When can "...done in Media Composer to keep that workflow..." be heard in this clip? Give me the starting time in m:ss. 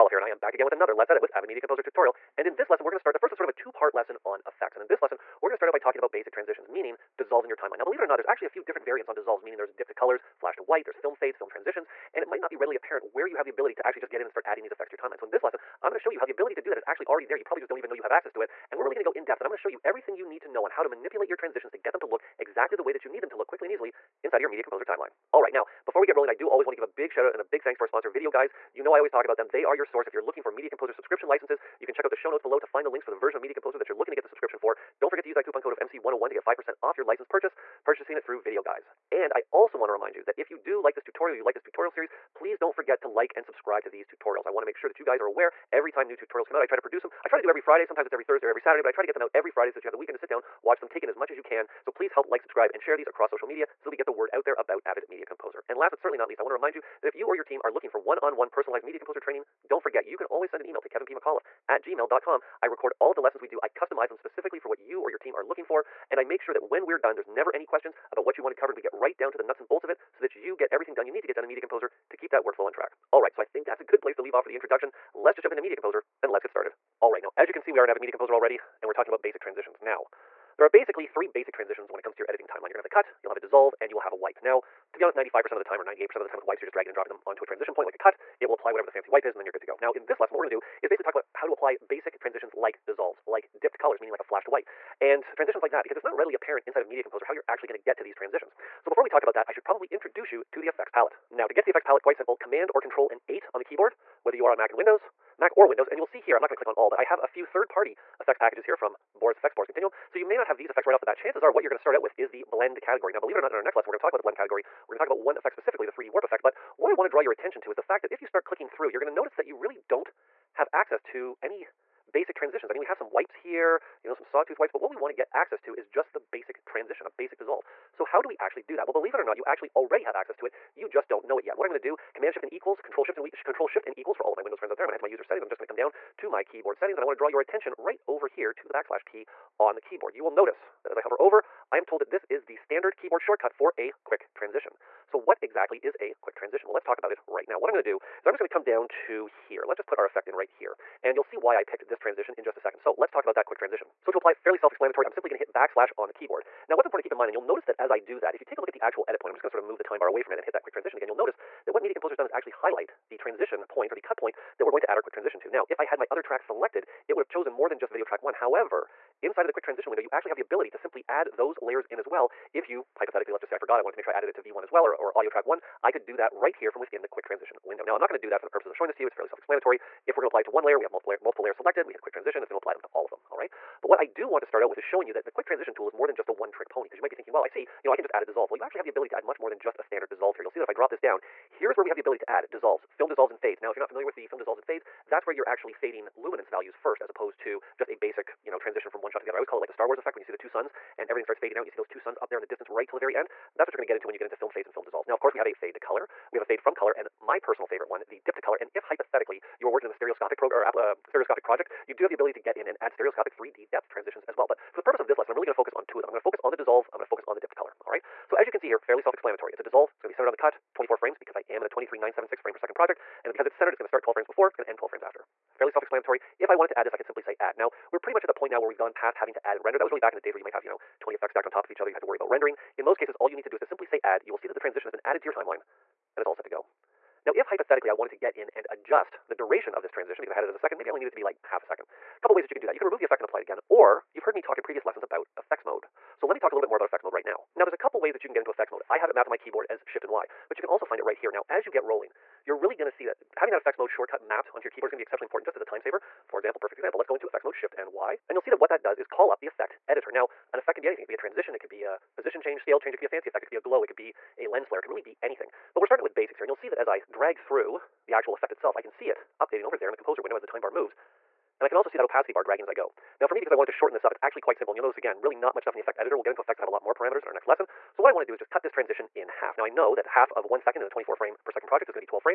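1:11.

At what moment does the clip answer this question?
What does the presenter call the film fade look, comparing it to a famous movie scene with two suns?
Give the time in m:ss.
3:19.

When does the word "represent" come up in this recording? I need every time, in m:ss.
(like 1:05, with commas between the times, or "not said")
not said.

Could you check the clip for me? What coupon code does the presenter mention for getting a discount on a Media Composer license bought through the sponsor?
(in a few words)
MC101.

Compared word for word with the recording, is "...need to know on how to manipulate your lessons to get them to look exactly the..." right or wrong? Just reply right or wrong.
wrong.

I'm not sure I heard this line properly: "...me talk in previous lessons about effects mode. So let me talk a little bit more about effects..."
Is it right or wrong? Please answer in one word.
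right.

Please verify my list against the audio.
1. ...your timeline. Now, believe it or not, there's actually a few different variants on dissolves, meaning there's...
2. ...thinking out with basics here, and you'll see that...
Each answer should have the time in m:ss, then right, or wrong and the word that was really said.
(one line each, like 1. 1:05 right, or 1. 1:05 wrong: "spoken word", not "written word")
1. 0:07 right
2. 4:25 wrong: "starting", not "thinking".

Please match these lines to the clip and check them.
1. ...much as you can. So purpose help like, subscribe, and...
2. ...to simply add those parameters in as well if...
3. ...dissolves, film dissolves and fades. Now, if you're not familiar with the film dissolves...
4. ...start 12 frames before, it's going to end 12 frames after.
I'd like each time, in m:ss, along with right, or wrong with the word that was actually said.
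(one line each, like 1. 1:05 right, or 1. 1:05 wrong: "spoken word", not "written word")
1. 0:51 wrong: "please", not "purpose"
2. 2:50 wrong: "layers", not "parameters"
3. 3:12 right
4. 3:43 right.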